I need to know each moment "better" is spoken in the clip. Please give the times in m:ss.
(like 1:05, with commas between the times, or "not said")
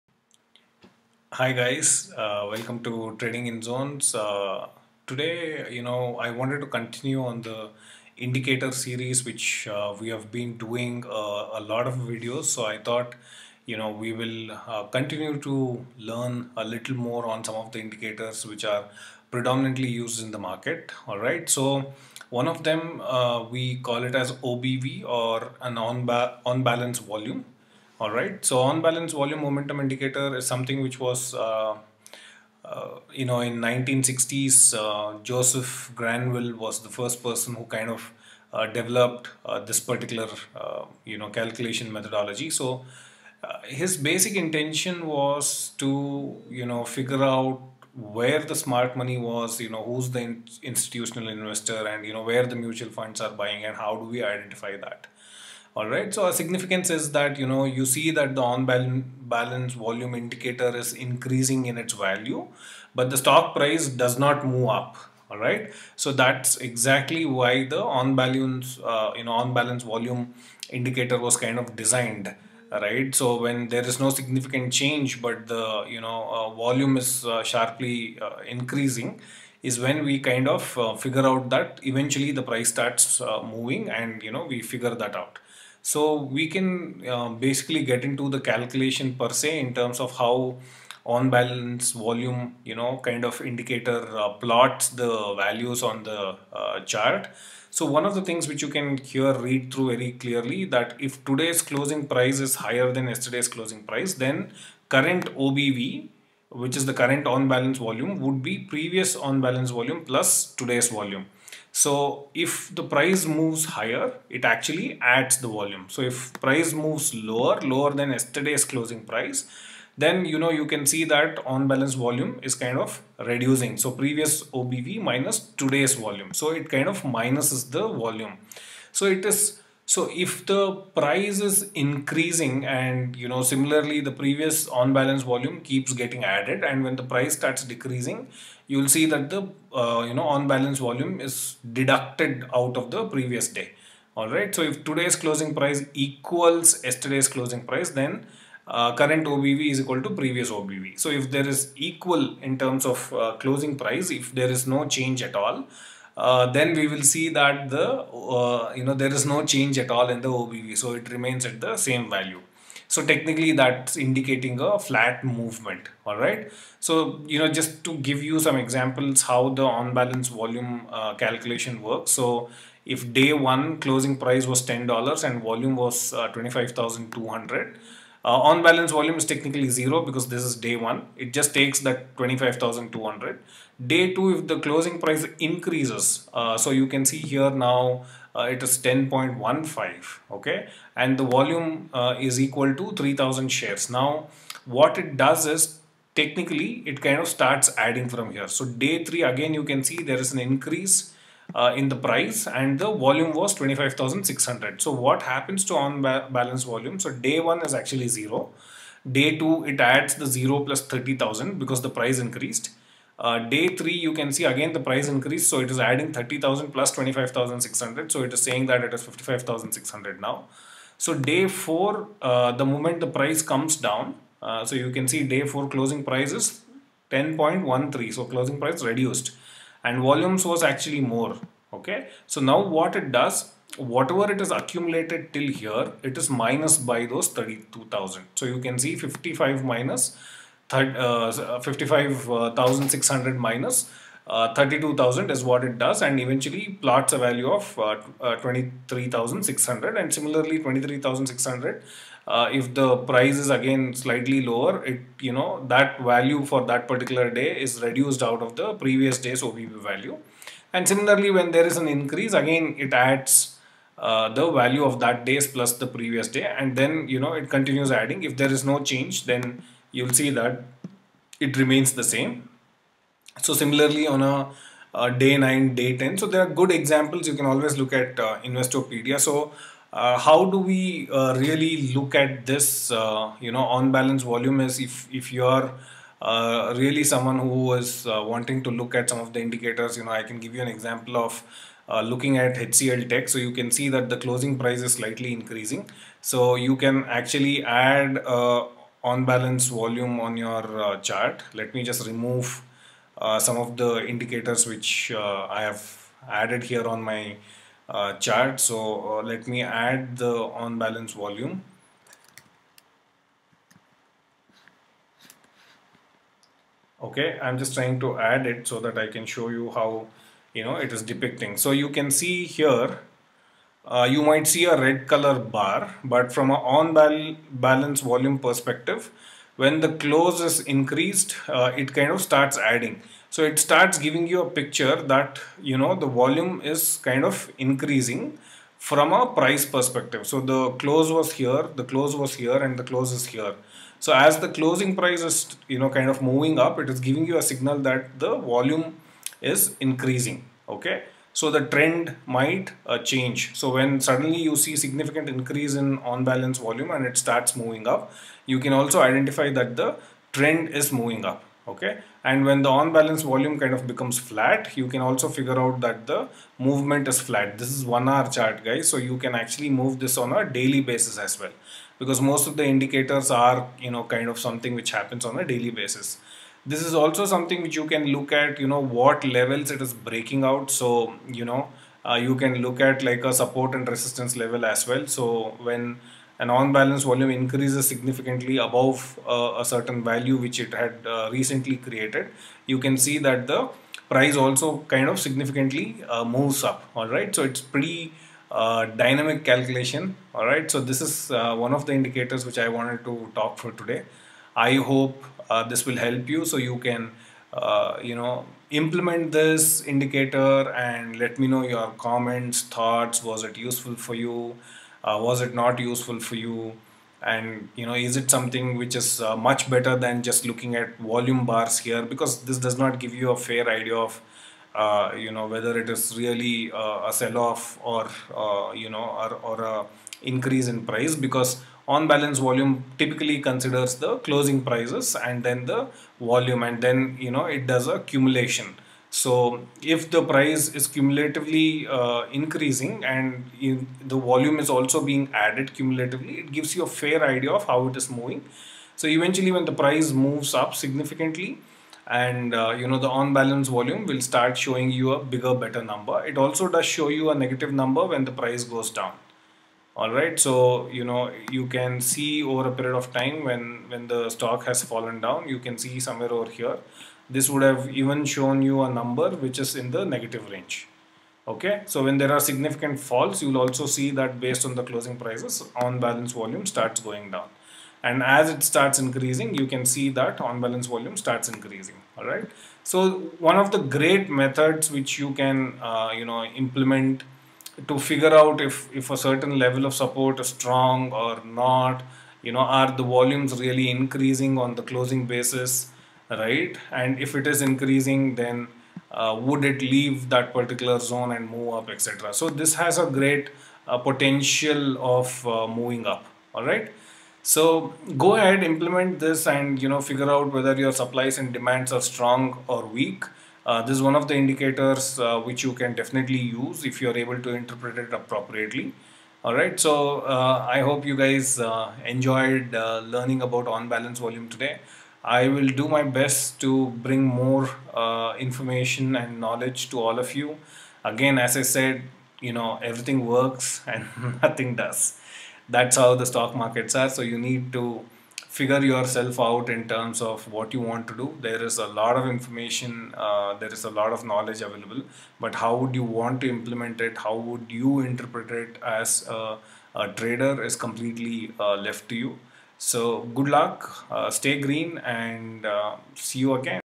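6:59, 7:35.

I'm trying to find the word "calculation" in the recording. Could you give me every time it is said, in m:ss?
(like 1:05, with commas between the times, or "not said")
0:41, 1:28, 2:51, 6:39.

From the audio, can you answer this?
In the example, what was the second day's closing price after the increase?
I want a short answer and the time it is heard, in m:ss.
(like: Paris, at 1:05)
10.15, at 3:08.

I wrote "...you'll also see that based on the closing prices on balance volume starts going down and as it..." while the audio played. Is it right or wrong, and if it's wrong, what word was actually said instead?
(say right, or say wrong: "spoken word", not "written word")
right.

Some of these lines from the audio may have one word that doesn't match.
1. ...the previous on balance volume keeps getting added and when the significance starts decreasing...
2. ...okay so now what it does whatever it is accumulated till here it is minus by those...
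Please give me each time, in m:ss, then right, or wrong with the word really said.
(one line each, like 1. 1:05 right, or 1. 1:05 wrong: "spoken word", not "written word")
1. 2:13 wrong: "price", not "significance"
2. 3:51 right.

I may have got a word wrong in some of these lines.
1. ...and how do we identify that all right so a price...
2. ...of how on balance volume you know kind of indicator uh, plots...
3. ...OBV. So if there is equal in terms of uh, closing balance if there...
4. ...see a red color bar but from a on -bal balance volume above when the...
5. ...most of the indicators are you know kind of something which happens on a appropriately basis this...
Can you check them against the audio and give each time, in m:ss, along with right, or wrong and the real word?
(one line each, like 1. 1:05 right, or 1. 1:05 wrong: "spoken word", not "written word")
1. 0:53 wrong: "significance", not "price"
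2. 1:29 right
3. 2:30 wrong: "price", not "balance"
4. 5:24 wrong: "perspective", not "above"
5. 6:12 wrong: "daily", not "appropriately".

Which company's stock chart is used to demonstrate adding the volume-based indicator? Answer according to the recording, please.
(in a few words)
HCL Tech.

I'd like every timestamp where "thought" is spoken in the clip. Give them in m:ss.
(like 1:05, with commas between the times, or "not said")
0:12, 6:52.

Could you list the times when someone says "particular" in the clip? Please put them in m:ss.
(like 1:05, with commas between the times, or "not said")
0:39, 4:16, 8:20.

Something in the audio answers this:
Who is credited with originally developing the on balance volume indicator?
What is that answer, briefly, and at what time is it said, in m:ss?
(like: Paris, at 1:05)
Joseph Granville, at 0:35.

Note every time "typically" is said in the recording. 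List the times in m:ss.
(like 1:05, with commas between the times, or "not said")
7:12.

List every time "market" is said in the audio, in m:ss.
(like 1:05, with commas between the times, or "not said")
0:20, 8:56.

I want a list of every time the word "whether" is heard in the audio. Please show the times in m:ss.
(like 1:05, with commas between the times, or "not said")
7:05, 8:30.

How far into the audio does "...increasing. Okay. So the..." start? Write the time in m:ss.
5:49.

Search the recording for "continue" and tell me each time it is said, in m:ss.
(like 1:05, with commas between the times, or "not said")
0:06, 0:14, 4:27.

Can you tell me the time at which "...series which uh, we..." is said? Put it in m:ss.
0:08.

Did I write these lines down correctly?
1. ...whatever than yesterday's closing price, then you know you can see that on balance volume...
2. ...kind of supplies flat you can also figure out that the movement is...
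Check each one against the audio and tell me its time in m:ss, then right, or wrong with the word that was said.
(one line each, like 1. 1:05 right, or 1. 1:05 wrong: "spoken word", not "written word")
1. 1:57 wrong: "lower", not "whatever"
2. 6:03 wrong: "becomes", not "supplies".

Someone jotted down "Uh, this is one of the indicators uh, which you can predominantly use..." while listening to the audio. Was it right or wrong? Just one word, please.
wrong.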